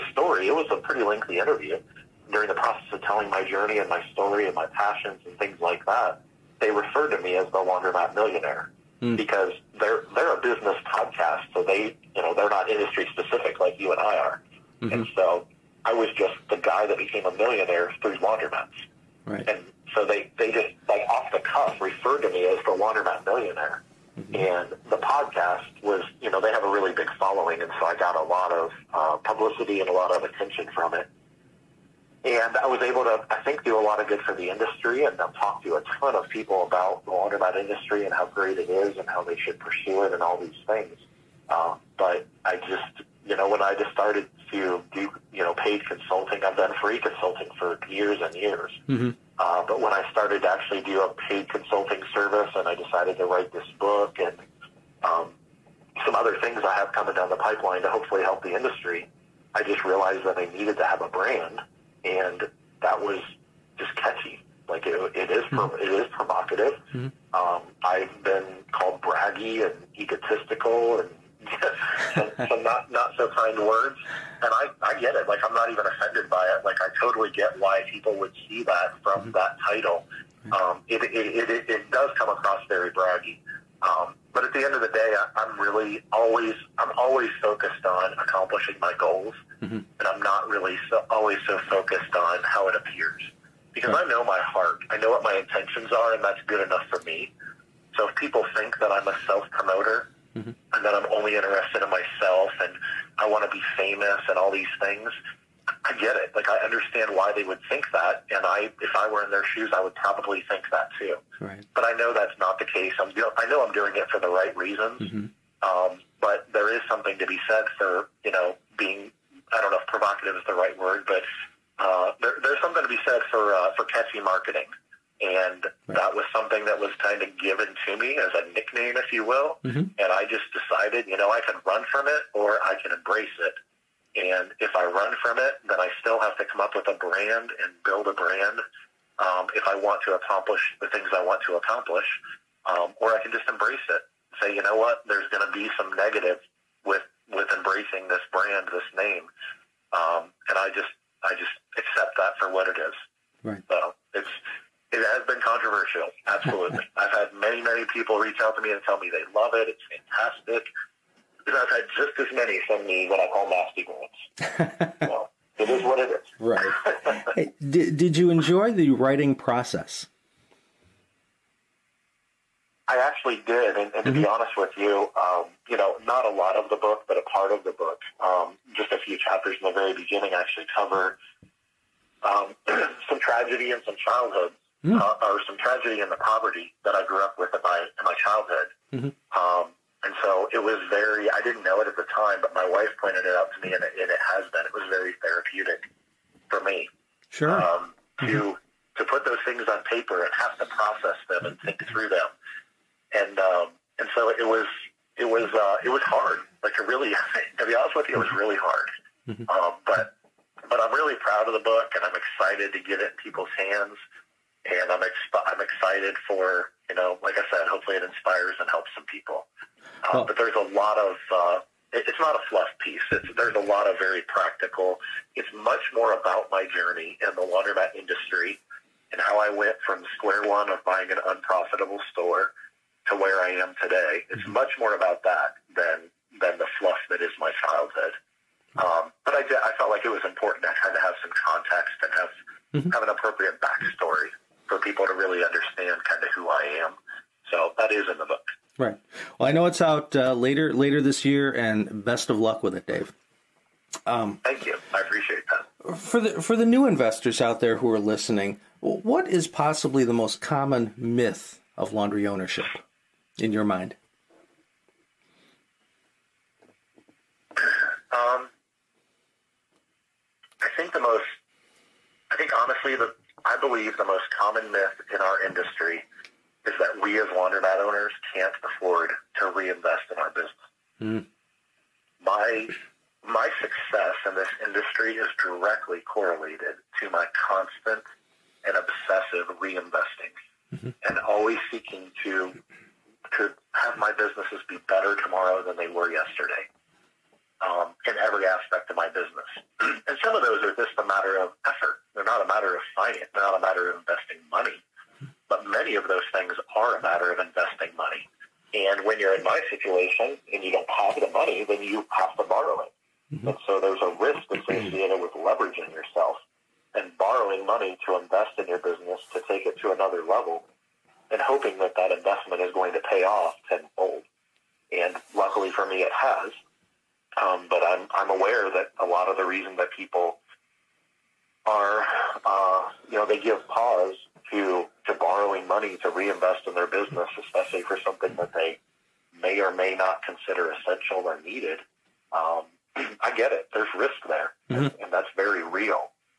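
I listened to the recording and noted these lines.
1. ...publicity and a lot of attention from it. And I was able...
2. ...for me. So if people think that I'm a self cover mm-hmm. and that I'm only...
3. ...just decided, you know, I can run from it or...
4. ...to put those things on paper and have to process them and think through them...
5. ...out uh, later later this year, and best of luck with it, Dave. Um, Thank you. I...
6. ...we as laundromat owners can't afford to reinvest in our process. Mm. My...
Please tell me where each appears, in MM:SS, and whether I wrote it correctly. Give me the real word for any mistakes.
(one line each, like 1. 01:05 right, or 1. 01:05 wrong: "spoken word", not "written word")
1. 00:29 right
2. 01:36 wrong: "promoter", not "cover"
3. 02:10 right
4. 03:18 right
5. 04:09 right
6. 04:37 wrong: "business", not "process".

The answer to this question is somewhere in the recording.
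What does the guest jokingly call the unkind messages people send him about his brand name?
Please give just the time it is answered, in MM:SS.
02:43.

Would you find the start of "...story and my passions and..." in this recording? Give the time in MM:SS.
00:04.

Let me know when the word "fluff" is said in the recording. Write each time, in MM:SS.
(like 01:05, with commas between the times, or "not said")
03:42, 03:56.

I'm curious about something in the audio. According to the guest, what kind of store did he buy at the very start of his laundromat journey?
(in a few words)
an unprofitable store.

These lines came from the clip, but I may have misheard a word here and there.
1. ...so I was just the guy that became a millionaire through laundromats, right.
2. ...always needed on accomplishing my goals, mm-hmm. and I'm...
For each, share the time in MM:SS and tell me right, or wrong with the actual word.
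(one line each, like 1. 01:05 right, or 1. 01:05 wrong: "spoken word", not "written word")
1. 00:15 right
2. 01:26 wrong: "focused", not "needed".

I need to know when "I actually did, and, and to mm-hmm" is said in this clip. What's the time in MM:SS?
02:52.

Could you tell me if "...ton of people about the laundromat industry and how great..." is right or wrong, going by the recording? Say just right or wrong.
right.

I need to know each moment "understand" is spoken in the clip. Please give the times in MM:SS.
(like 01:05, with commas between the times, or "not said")
01:46, 04:05.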